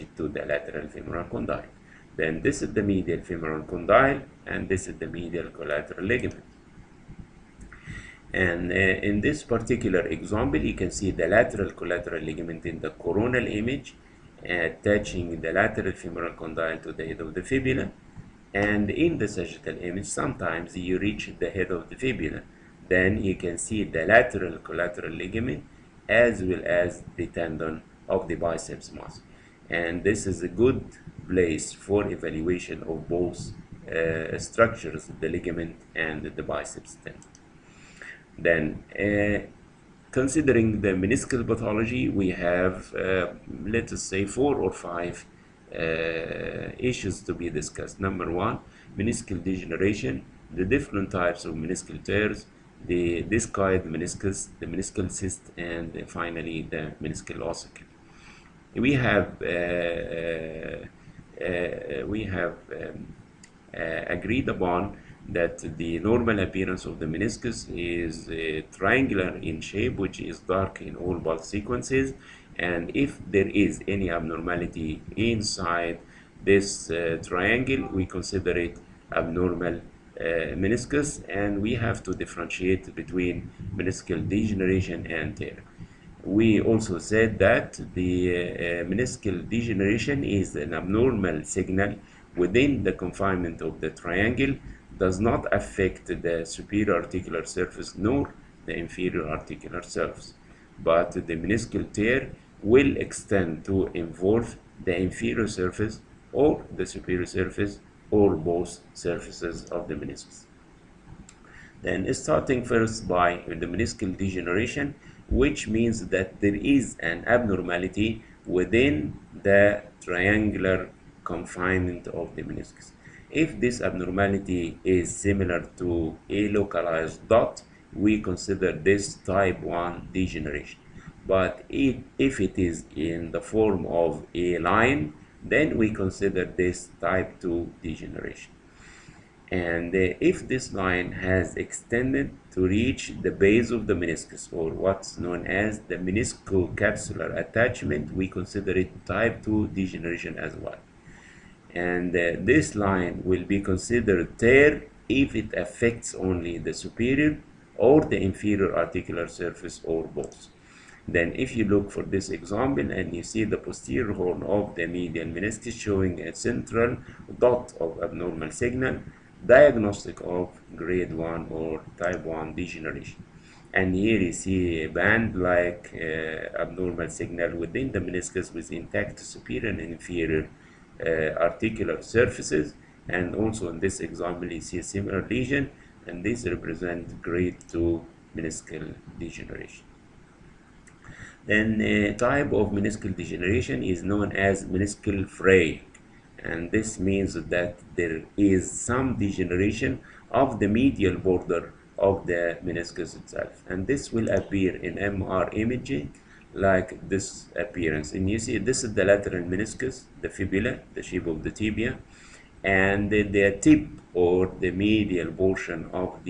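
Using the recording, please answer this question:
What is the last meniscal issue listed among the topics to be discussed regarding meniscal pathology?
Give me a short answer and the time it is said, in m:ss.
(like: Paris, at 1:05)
Meniscal ossicle, at 0:57.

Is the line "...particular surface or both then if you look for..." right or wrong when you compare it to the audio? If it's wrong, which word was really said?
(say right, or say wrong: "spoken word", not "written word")
wrong: "articular", not "particular".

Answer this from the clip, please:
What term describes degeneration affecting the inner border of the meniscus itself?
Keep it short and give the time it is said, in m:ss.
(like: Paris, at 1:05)
Meniscal fray, at 3:14.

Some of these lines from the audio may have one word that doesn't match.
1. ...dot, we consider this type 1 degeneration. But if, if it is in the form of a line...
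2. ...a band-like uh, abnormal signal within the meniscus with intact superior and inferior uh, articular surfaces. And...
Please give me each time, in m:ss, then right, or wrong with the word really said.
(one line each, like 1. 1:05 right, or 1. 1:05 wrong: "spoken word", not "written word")
1. 2:07 right
2. 2:54 right.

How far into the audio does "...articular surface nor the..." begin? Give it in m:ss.
1:36.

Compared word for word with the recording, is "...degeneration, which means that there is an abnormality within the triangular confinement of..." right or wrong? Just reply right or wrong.
right.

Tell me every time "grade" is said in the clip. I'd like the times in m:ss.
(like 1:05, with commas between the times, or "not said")
2:50, 3:07.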